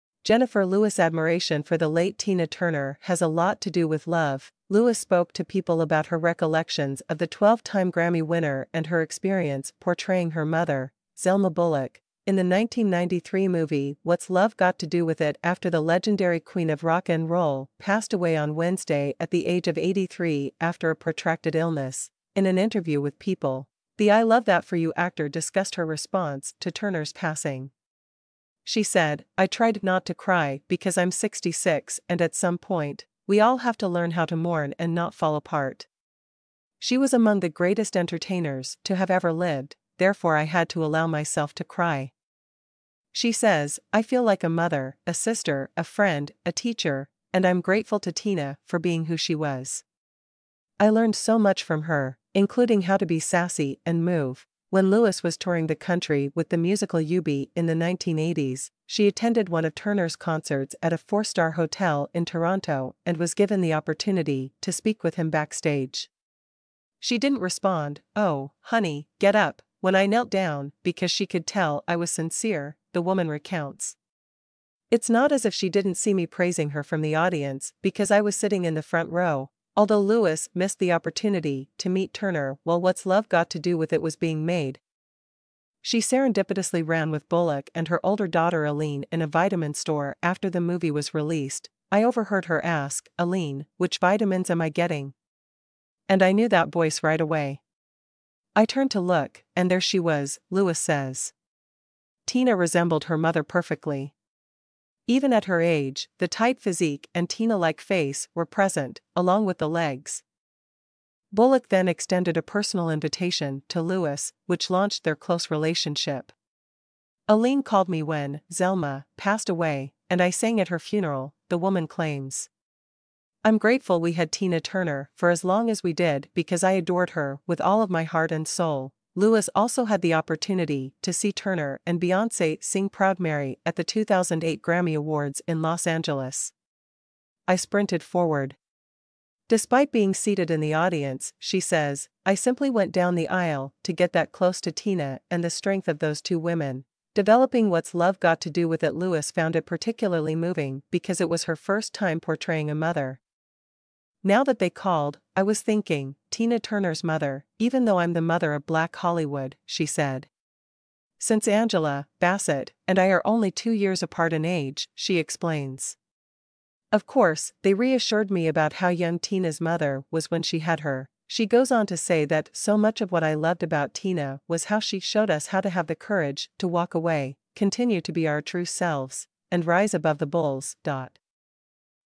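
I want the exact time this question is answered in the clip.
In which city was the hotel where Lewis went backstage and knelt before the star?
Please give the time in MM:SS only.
01:02.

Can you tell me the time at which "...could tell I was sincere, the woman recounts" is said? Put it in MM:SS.
01:11.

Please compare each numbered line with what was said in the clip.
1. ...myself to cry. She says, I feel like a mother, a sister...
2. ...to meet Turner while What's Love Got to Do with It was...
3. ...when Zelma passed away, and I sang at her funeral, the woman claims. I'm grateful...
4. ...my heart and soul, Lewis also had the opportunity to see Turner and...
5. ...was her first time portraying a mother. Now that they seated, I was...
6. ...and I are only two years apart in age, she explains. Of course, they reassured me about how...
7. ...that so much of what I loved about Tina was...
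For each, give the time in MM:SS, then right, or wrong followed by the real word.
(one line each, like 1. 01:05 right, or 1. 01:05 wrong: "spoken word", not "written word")
1. 00:41 right
2. 01:21 right
3. 01:58 right
4. 02:07 right
5. 02:31 wrong: "called", not "seated"
6. 02:42 right
7. 02:52 right.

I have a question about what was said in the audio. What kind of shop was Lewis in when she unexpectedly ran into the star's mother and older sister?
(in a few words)
vitamin store.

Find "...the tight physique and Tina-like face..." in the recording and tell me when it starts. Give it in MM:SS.
01:46.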